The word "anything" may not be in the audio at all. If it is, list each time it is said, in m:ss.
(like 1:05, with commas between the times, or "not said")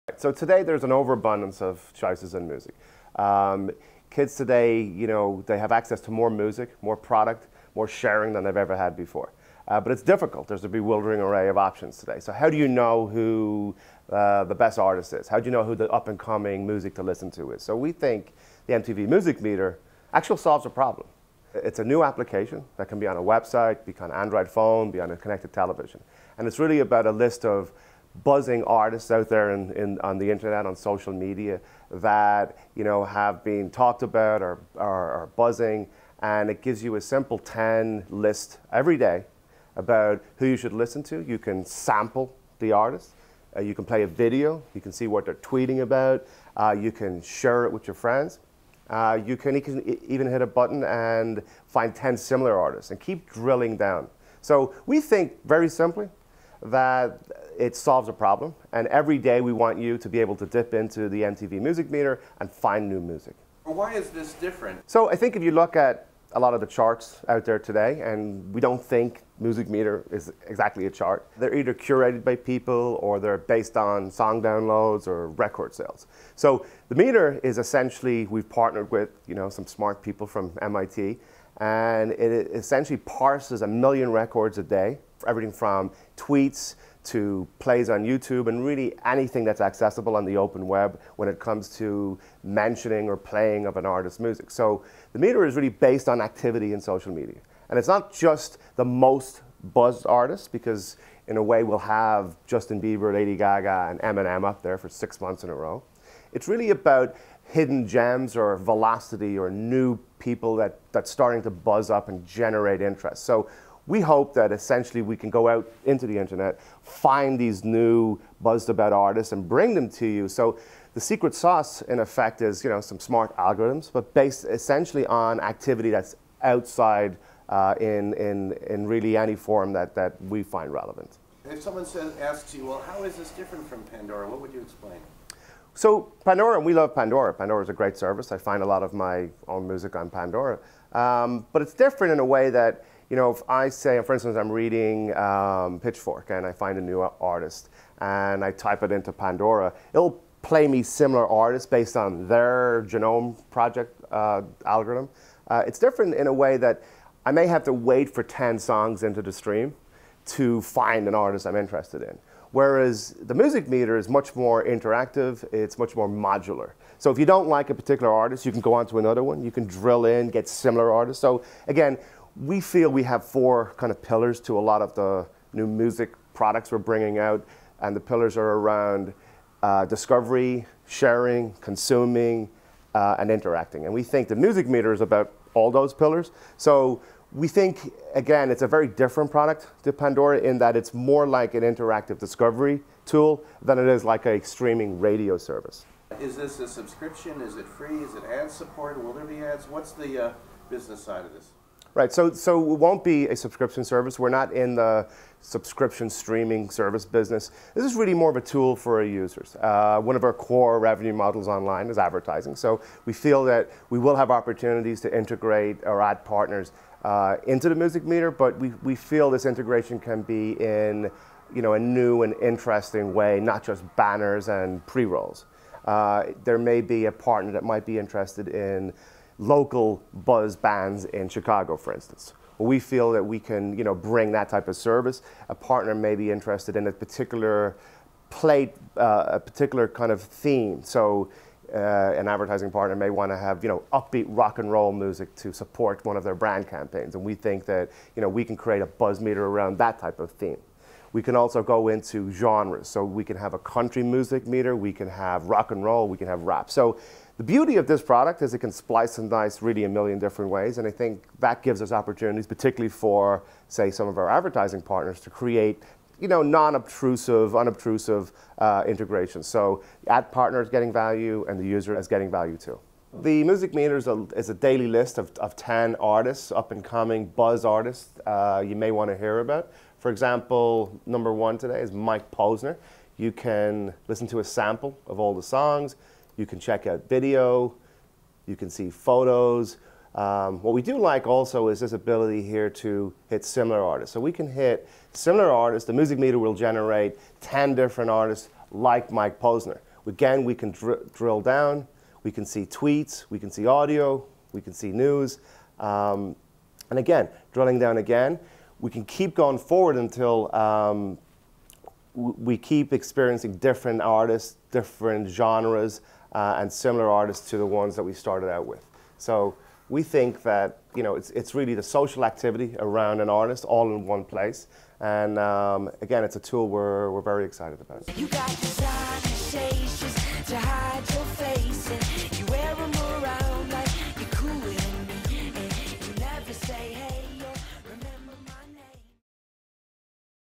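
1:29.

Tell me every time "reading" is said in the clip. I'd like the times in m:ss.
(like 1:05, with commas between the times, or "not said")
2:24.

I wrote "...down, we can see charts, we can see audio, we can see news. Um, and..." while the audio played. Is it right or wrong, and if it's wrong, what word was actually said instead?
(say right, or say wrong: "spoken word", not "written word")
wrong: "tweets", not "charts".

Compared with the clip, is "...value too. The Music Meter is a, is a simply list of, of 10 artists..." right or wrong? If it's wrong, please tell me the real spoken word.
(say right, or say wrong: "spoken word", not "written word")
wrong: "daily", not "simply".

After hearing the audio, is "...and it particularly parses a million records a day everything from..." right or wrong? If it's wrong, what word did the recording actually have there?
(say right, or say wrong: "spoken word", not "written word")
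wrong: "essentially", not "particularly".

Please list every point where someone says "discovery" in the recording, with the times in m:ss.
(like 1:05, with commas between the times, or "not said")
2:59, 3:12.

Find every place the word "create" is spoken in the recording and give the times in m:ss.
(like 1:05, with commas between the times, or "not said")
4:08, 4:25.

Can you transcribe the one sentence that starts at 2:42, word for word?
Whereas the music meter is much more interactive, it's much more modular.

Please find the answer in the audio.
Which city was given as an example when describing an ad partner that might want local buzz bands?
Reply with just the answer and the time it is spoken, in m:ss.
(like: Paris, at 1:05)
Chicago, at 3:51.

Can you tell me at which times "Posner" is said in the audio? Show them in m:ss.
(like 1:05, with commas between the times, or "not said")
4:42, 4:59.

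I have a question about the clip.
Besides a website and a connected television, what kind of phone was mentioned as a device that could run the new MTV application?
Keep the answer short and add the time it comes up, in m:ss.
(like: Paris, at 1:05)
Android, at 0:24.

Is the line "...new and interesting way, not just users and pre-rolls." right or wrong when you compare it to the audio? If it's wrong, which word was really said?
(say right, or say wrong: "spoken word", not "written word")
wrong: "banners", not "users".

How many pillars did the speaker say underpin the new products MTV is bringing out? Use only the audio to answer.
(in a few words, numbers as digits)
4.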